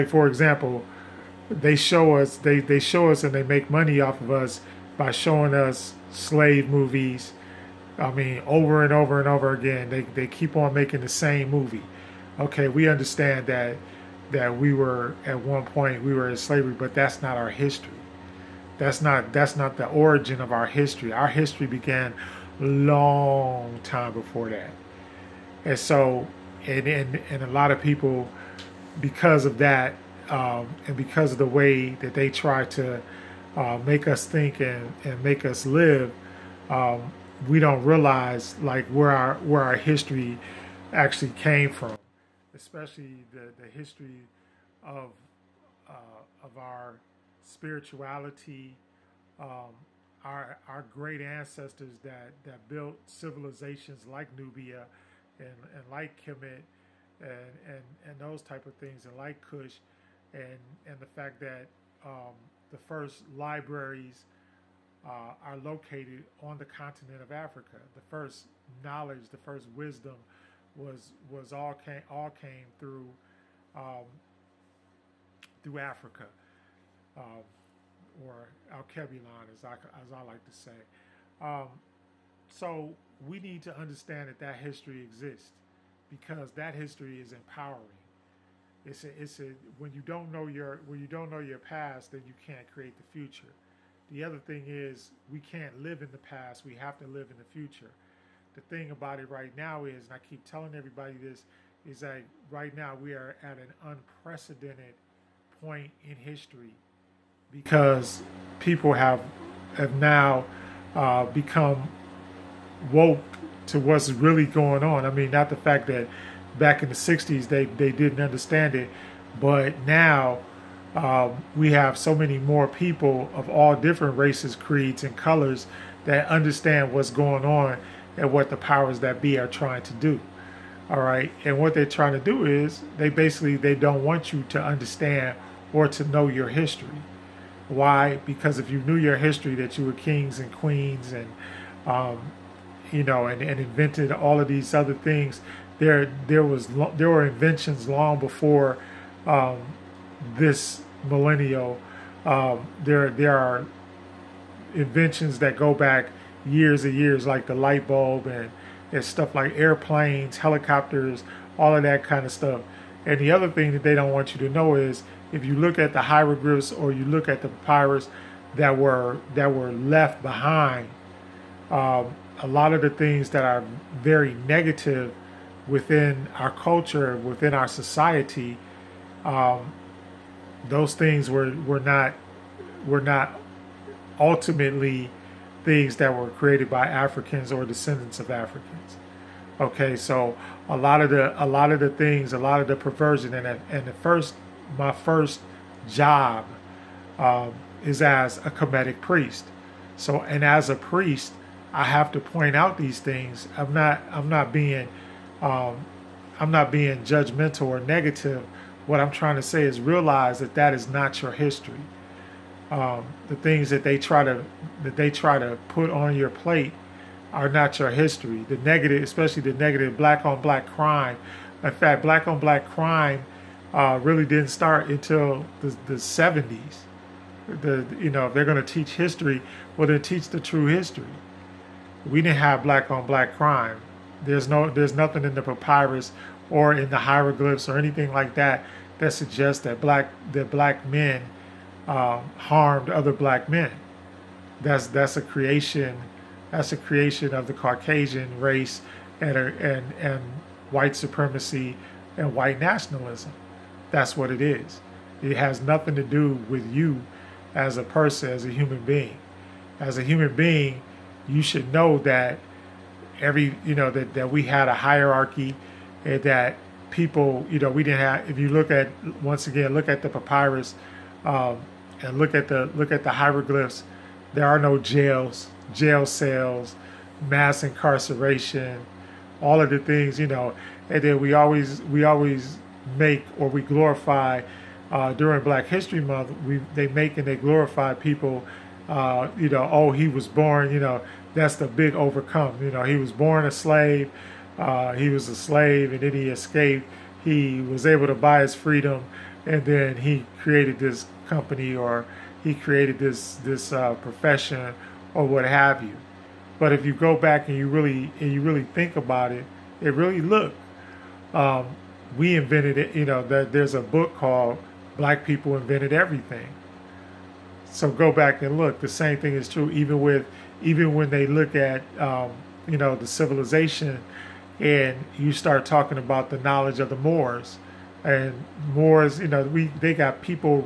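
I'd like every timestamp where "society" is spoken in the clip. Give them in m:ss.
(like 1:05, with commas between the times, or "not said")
2:57.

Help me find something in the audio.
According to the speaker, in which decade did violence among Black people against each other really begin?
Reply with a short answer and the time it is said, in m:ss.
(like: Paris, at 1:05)
1970s, at 3:45.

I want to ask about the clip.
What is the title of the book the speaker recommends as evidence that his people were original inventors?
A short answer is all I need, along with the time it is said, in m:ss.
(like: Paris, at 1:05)
Black People Invented Everything, at 5:14.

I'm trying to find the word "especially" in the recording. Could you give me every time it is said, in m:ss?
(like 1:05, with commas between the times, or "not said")
0:42, 3:39.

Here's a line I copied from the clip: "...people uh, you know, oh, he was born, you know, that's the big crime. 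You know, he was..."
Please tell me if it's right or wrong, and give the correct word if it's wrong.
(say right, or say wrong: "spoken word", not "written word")
wrong: "overcome", not "crime".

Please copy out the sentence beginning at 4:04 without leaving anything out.
That's that's a creation that's a creation of the Caucasian race and and and white supremacy and white nationalism.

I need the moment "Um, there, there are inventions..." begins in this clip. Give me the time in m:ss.
2:32.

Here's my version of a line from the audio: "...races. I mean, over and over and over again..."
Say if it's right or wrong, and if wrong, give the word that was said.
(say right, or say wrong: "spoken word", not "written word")
wrong: "movies", not "races".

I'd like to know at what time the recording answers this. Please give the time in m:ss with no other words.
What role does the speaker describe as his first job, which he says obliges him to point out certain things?
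3:18.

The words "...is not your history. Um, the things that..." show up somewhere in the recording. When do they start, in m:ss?
3:30.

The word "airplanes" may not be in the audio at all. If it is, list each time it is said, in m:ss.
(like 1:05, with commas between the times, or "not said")
2:39.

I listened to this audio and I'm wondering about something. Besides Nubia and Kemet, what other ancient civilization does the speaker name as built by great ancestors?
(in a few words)
Kush.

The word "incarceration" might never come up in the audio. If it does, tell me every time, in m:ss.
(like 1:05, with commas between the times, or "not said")
4:37.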